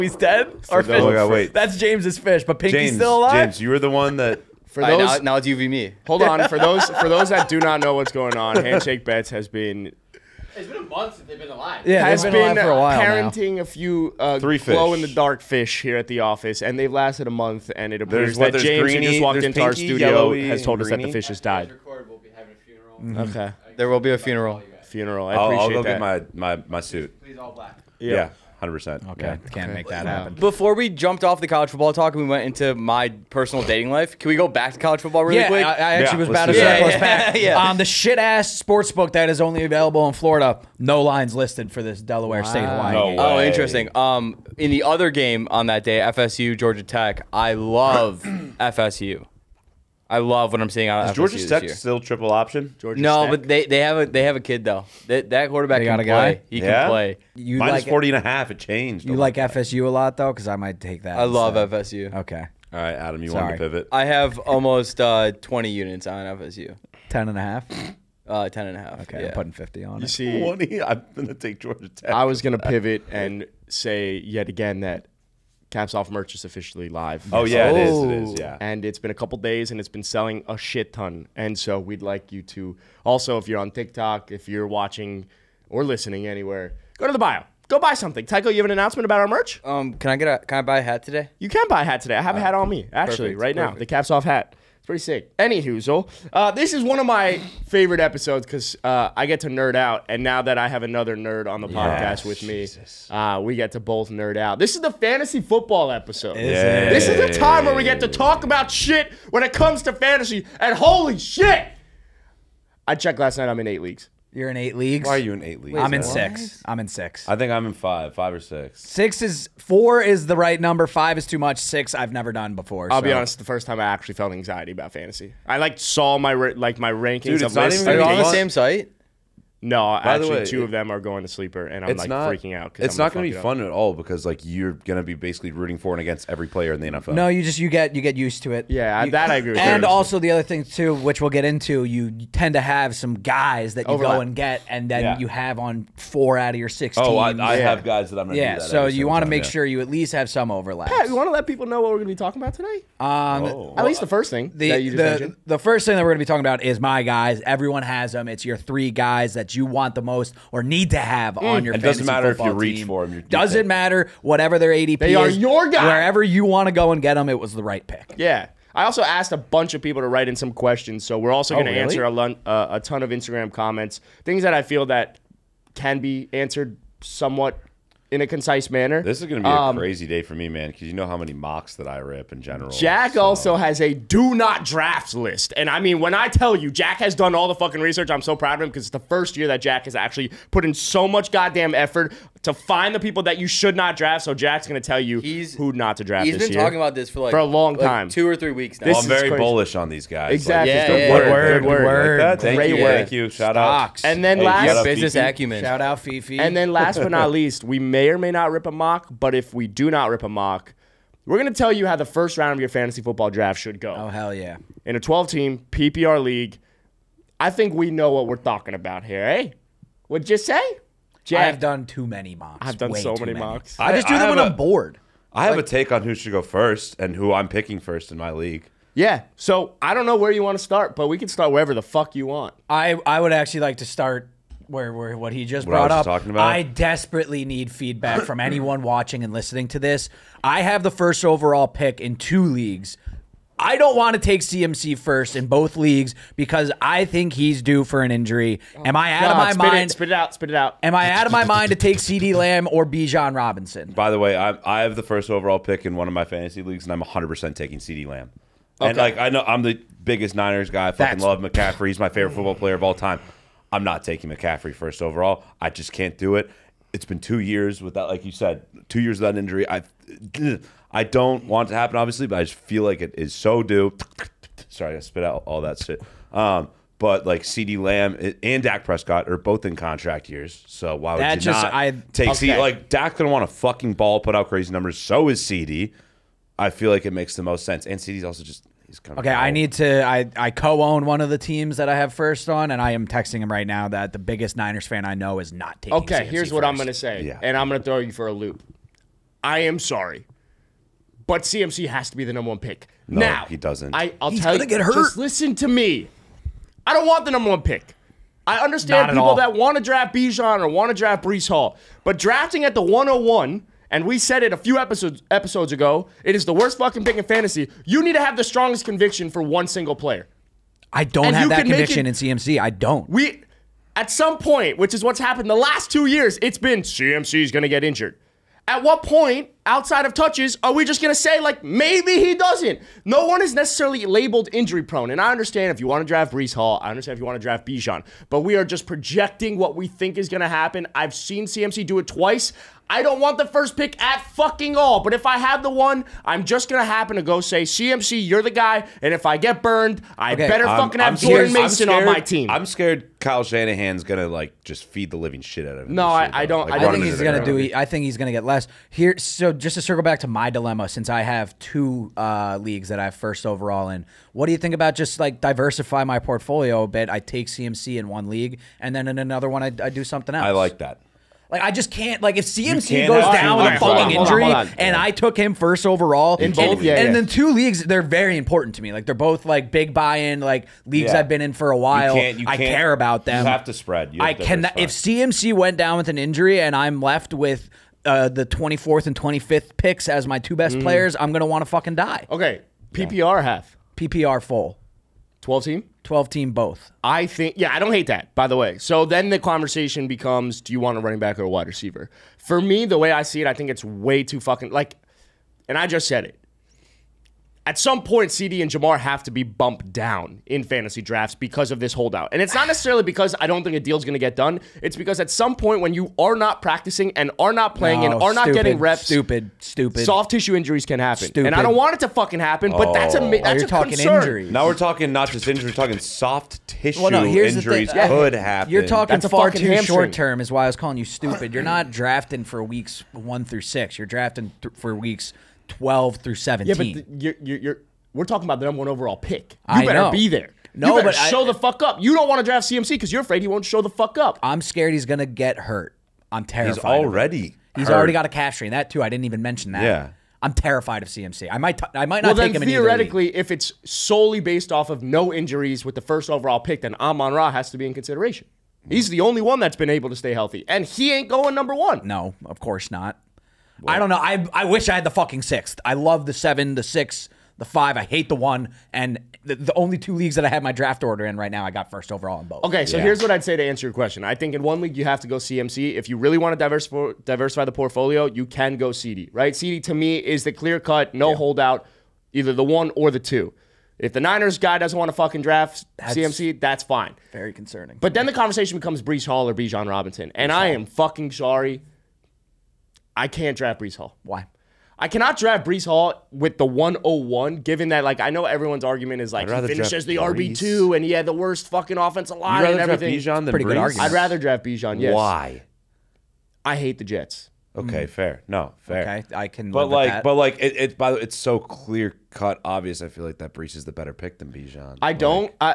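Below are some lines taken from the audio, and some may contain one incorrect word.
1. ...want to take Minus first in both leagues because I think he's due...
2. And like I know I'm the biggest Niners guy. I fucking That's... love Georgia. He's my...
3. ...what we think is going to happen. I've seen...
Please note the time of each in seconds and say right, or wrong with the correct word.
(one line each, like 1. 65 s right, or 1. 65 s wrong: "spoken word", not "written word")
1. 243 s wrong: "CMC", not "Minus"
2. 258 s wrong: "McCaffrey", not "Georgia"
3. 339 s right.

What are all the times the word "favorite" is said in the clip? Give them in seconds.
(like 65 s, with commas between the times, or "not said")
97 s, 262 s.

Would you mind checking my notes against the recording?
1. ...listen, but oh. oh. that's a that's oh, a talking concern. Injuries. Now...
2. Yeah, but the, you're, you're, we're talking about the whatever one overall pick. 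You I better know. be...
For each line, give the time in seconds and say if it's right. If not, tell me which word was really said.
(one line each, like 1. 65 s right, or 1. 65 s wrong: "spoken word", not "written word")
1. 422 s wrong: "happen", not "listen"
2. 436 s wrong: "number", not "whatever".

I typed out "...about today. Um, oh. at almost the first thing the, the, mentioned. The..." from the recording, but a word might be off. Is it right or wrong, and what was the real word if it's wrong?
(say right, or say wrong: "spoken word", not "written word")
wrong: "least", not "almost".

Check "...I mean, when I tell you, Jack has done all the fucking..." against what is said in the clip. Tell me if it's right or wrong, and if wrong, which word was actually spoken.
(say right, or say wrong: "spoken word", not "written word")
right.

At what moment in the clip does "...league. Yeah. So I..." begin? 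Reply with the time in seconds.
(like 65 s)
228 s.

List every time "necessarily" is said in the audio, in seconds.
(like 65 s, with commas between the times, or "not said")
333 s, 412 s.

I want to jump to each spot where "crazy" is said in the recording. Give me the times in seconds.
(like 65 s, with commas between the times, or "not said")
179 s, 199 s, 284 s.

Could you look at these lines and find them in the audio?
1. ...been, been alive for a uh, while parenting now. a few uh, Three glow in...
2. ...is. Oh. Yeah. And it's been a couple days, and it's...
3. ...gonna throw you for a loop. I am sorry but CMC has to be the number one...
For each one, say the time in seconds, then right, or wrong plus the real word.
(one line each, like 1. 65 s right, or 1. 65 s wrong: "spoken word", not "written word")
1. 12 s right
2. 78 s right
3. 297 s right.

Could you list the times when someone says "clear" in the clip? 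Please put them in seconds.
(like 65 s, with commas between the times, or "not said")
480 s, 511 s.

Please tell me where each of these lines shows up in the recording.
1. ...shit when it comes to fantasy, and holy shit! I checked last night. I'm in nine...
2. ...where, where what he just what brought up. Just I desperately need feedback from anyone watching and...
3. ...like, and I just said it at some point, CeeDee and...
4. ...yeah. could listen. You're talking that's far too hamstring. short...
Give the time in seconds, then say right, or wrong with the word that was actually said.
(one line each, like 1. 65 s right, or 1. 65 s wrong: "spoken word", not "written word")
1. 108 s wrong: "eight", not "nine"
2. 234 s right
3. 404 s right
4. 427 s wrong: "happen", not "listen".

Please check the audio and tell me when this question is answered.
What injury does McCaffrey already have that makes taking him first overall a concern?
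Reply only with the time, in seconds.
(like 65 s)
448 s.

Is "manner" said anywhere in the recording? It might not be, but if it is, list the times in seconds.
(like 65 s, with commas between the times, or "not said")
178 s.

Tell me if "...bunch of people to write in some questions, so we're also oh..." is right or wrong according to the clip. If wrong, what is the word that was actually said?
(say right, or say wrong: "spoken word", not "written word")
right.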